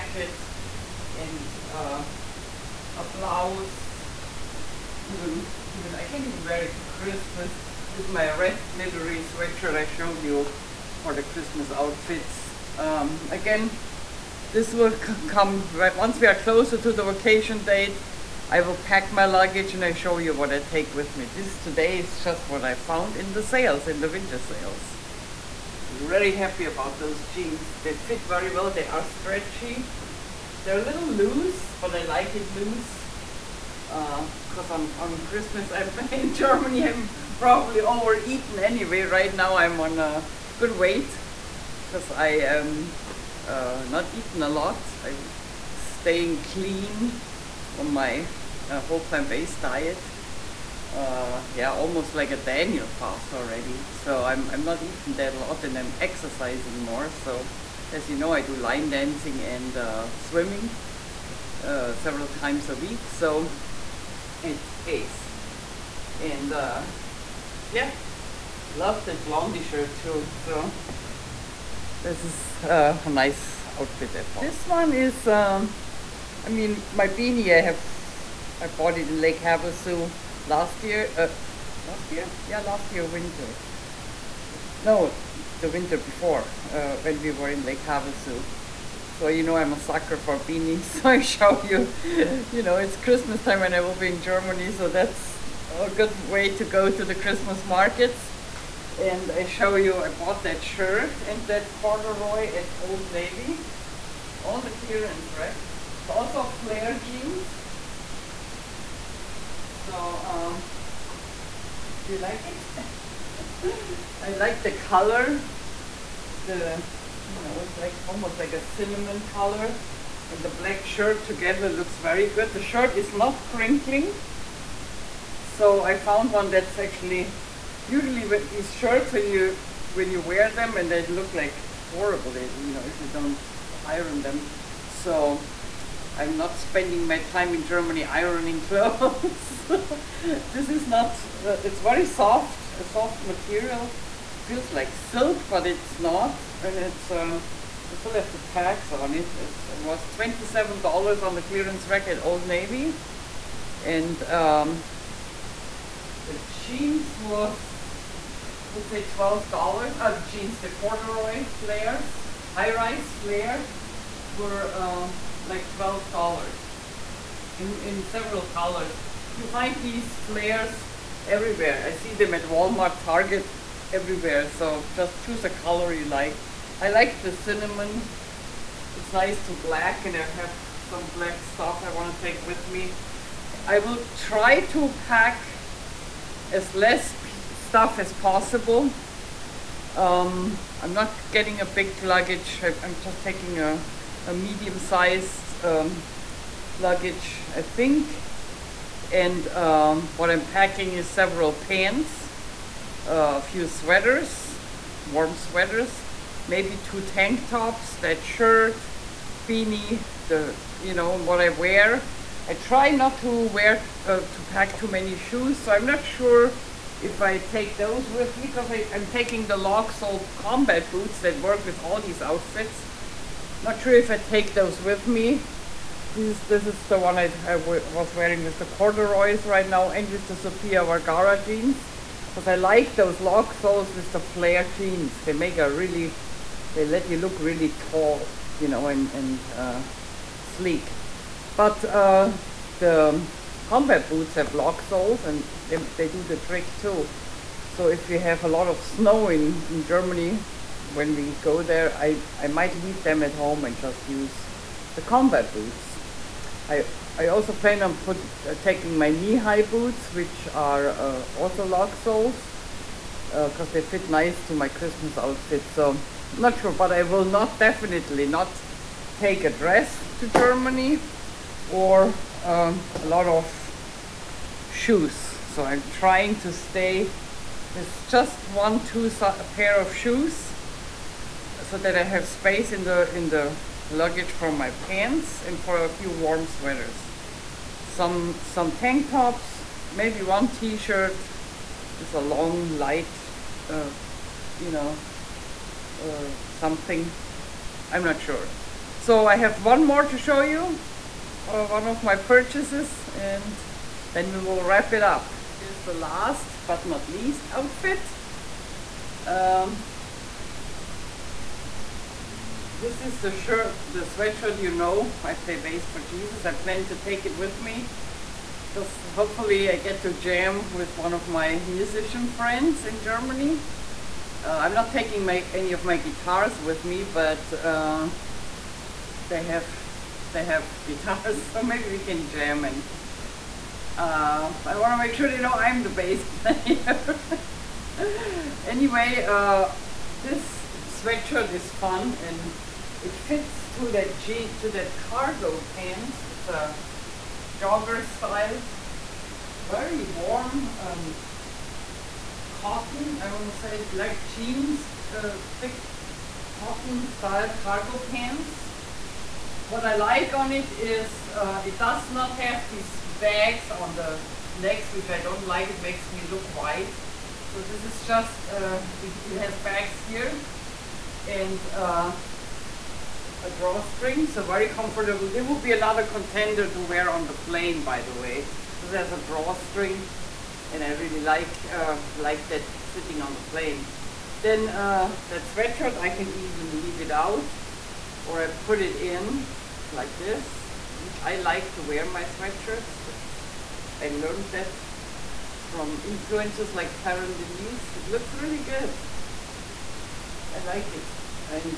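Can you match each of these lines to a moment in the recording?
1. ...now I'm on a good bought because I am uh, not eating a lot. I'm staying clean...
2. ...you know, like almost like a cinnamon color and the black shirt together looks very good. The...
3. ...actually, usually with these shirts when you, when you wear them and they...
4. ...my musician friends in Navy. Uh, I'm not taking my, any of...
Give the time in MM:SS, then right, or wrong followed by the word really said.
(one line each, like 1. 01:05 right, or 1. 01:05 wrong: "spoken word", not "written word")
1. 00:39 wrong: "weight", not "bought"
2. 01:57 right
3. 02:06 right
4. 05:21 wrong: "Germany", not "Navy".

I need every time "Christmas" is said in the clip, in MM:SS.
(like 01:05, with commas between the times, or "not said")
00:06, 00:11, 00:35, 01:32, 01:37, 04:24.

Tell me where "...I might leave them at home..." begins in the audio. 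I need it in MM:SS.
04:12.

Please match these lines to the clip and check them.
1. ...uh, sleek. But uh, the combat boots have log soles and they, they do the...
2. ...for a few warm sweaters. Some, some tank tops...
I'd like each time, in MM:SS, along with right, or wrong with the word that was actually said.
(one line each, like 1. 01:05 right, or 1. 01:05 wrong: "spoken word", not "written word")
1. 03:59 right
2. 04:45 right.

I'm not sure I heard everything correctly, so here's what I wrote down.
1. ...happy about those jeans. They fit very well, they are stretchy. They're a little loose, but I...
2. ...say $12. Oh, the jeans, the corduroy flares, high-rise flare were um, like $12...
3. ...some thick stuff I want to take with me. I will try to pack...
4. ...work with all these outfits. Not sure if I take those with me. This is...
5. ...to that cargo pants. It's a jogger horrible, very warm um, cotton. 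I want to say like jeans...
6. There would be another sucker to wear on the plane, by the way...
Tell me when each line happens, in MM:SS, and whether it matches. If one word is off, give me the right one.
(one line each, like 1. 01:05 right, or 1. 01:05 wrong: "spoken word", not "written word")
1. 00:26 right
2. 02:38 right
3. 03:00 wrong: "black", not "thick"
4. 03:41 right
5. 05:44 wrong: "style", not "horrible"
6. 06:15 wrong: "contender", not "sucker".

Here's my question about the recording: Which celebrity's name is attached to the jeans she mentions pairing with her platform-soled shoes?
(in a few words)
Sofia Vergara.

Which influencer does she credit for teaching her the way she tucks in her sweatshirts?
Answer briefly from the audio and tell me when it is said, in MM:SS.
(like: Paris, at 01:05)
Taryn Denise, at 06:37.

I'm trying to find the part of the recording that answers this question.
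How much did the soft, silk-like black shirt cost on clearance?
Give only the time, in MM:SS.
02:30.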